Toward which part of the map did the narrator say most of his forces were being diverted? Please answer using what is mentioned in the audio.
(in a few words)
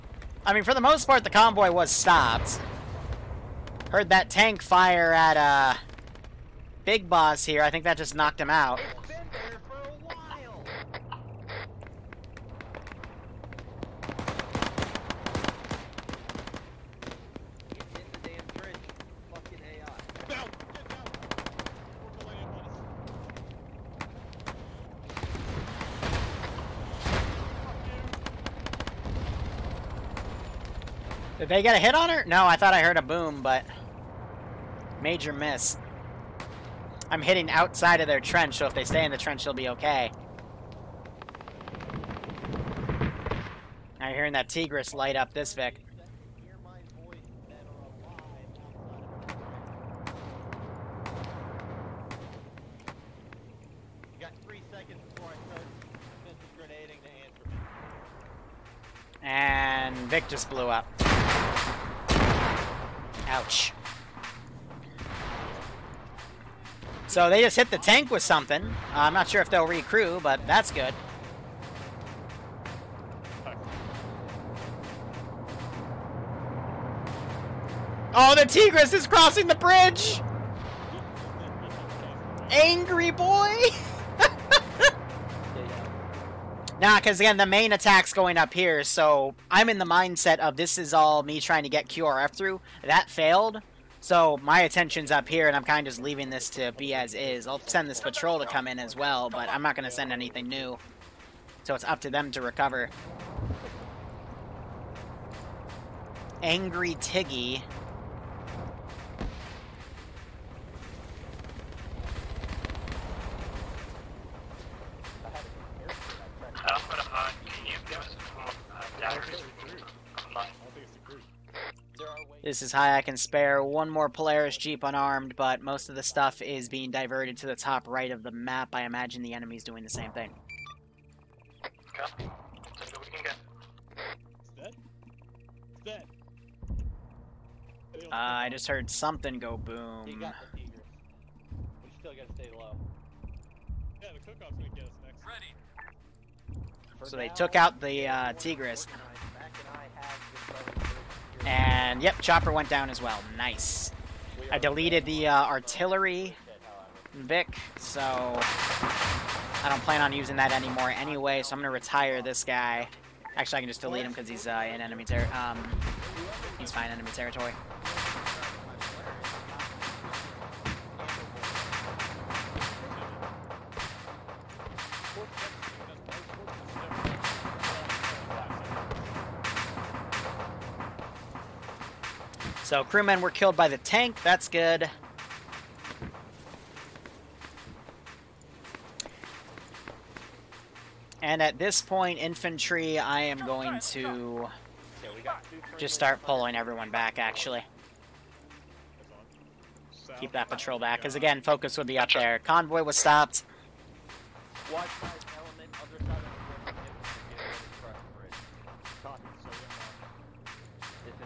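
top right.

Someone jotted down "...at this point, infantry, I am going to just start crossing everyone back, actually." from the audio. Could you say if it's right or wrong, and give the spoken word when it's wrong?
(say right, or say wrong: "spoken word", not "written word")
wrong: "pulling", not "crossing".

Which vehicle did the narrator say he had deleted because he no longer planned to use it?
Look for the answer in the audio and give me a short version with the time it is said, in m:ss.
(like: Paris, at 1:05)
artillery Vic, at 2:35.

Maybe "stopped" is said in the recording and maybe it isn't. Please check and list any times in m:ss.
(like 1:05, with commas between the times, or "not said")
0:01, 3:22.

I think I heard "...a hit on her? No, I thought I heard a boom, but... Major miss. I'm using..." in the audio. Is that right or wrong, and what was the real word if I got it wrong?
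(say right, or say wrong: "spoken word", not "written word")
wrong: "hitting", not "using".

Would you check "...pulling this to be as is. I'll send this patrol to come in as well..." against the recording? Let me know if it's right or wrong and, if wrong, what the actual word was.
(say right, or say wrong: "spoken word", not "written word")
wrong: "leaving", not "pulling".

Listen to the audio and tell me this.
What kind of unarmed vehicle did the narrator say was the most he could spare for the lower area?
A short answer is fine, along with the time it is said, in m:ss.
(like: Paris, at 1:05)
Polaris Jeep, at 2:04.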